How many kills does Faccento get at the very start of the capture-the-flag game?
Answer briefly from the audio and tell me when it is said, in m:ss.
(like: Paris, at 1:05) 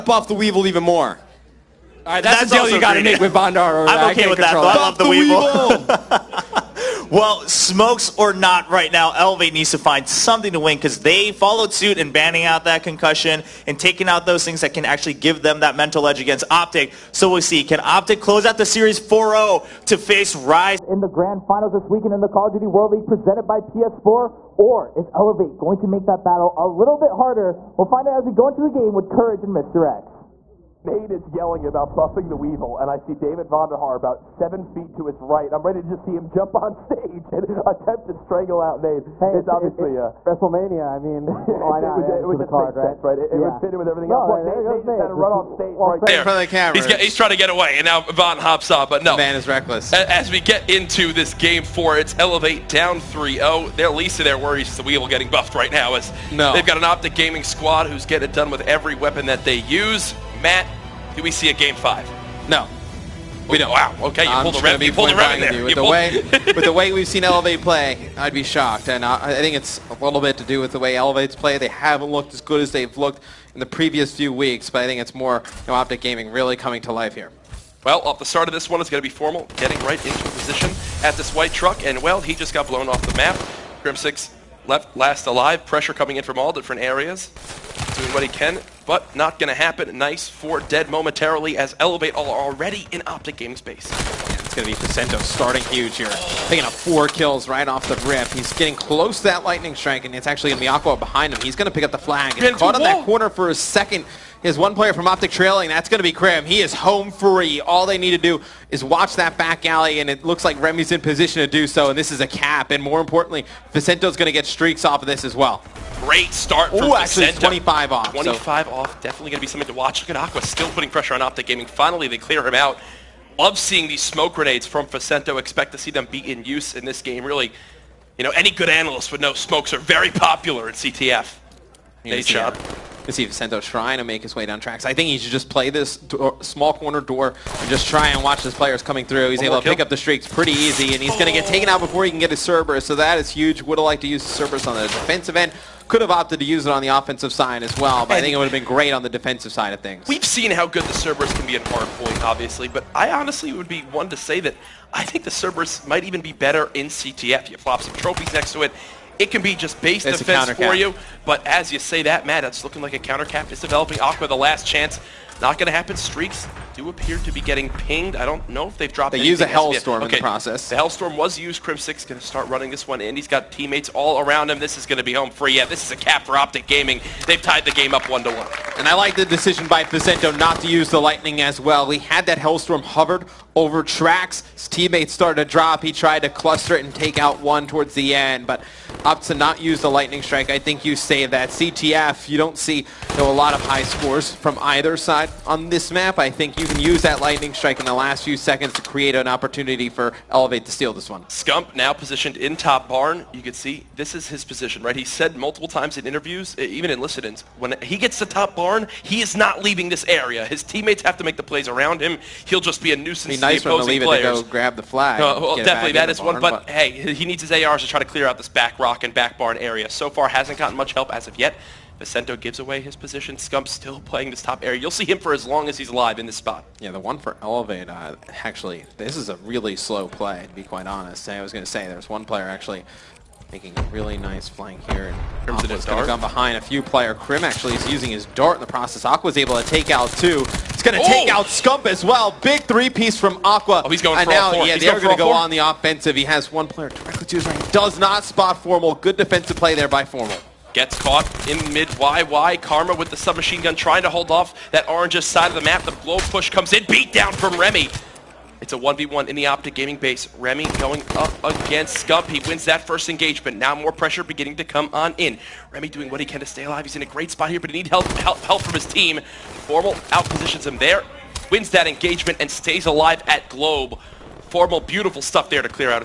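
4, at 1:36.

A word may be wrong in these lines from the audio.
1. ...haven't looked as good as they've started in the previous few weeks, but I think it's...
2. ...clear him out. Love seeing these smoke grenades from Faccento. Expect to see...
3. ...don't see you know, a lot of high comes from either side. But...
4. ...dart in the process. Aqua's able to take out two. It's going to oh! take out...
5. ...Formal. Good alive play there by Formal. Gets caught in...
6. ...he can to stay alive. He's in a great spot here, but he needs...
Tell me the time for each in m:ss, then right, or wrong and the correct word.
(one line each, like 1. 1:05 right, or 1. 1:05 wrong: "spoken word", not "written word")
1. 1:11 wrong: "looked", not "started"
2. 2:02 right
3. 3:12 wrong: "scores", not "comes"
4. 3:58 right
5. 4:08 wrong: "defensive", not "alive"
6. 4:26 right.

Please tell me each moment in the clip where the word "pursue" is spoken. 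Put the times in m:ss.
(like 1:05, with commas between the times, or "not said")
not said.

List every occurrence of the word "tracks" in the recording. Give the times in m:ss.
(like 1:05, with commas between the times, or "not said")
2:14, 3:03.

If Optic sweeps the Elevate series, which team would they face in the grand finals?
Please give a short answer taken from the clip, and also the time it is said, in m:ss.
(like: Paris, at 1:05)
Rise, at 0:20.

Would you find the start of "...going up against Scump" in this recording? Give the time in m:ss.
4:20.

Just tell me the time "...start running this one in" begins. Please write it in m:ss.
2:52.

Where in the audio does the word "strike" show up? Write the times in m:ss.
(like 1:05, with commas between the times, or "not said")
1:39, 3:10, 3:17.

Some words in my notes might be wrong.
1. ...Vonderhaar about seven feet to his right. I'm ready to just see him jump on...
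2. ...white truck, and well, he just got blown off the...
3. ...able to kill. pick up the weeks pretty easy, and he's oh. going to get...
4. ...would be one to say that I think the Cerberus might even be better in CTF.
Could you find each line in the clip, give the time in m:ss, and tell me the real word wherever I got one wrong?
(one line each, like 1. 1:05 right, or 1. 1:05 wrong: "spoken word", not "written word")
1. 0:33 right
2. 1:21 right
3. 2:19 wrong: "streaks", not "weeks"
4. 2:33 right.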